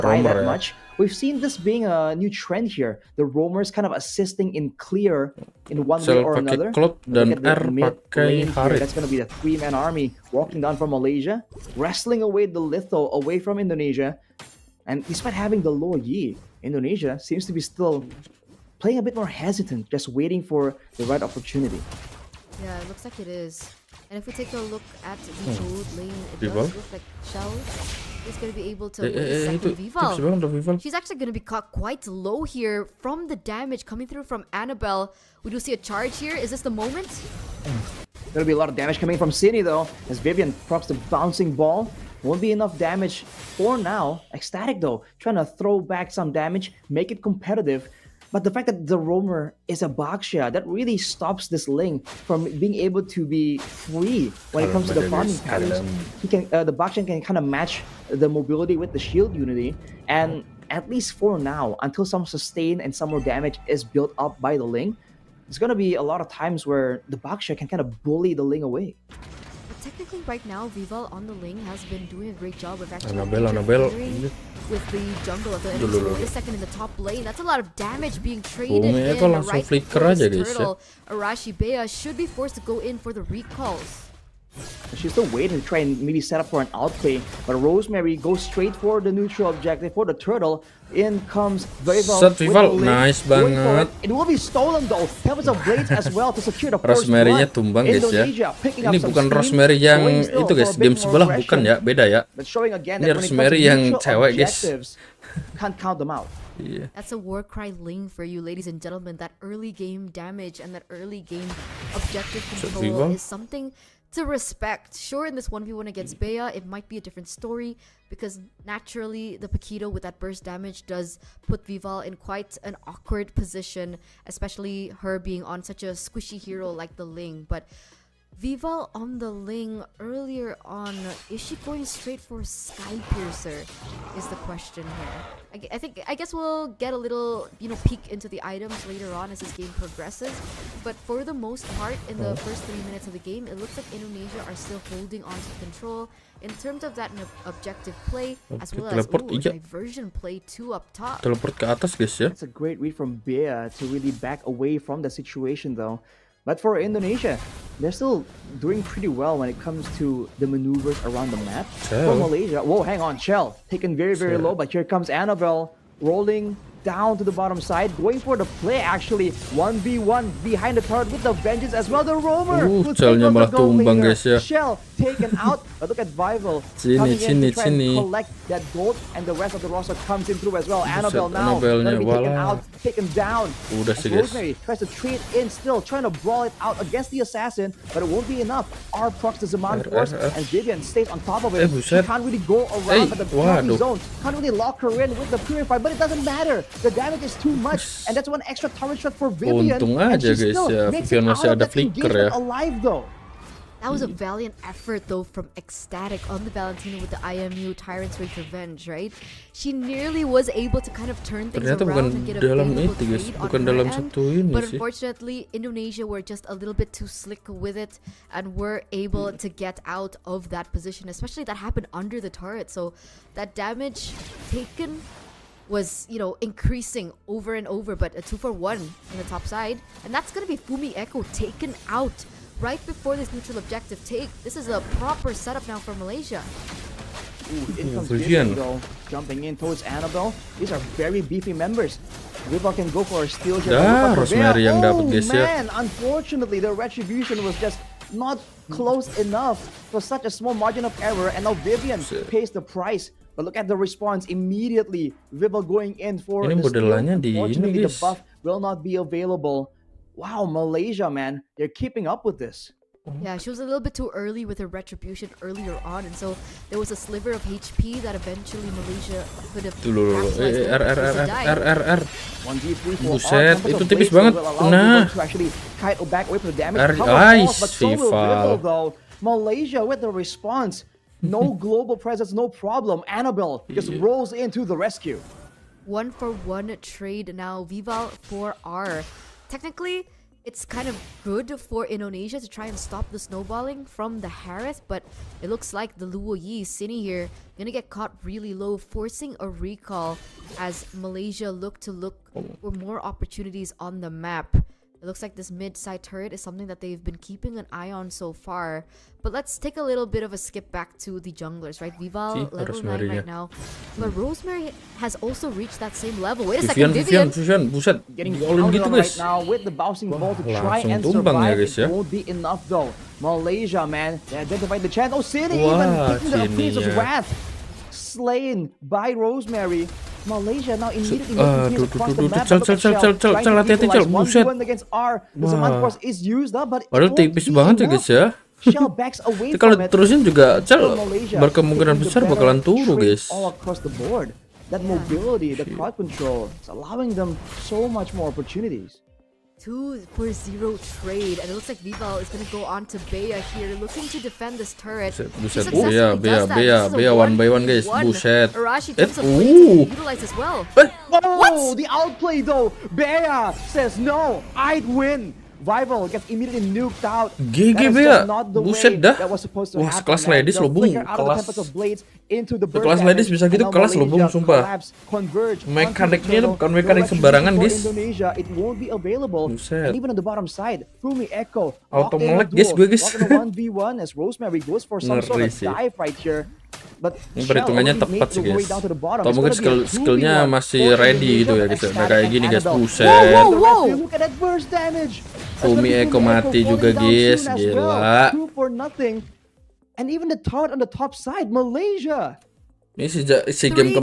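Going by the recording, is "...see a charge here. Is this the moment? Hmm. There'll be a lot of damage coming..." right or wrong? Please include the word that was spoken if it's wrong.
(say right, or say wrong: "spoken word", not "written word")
right.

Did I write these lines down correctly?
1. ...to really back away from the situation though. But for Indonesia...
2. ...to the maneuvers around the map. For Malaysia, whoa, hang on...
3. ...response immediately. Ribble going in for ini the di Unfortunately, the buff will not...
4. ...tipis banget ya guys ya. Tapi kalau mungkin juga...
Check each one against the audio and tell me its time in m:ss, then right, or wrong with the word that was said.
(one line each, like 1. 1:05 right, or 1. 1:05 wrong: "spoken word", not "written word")
1. 2:33 right
2. 2:39 right
3. 4:13 right
4. 5:37 wrong: "terusin", not "mungkin".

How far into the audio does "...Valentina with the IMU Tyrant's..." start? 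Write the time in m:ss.
3:26.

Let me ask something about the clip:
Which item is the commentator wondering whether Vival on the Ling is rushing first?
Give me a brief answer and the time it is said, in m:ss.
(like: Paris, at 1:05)
Skypiercer, at 2:12.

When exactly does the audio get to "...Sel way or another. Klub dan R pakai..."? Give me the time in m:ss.
0:06.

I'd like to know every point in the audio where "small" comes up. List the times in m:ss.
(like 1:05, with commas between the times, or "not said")
4:10.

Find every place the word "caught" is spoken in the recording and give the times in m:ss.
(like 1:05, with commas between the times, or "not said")
0:31, 4:57.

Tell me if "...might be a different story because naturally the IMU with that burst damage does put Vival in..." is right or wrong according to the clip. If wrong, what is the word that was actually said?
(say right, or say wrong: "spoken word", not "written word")
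wrong: "Paquito", not "IMU".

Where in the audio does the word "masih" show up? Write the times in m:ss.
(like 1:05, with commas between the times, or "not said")
3:21, 6:30.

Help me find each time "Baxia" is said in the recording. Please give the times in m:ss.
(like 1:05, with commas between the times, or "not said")
0:49, 0:56, 1:07.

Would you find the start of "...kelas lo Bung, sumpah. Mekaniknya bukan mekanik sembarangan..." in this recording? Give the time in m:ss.
6:13.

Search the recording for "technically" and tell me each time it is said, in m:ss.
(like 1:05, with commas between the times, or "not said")
1:09, 4:49.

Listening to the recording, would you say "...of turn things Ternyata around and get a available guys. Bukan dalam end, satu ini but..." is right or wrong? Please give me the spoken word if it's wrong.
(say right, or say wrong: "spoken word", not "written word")
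wrong: "valuable", not "available".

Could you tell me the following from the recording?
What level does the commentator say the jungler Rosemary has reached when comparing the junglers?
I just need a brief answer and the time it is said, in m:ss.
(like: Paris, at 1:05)
9, at 5:12.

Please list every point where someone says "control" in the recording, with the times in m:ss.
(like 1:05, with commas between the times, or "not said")
1:52, 2:25, 5:45.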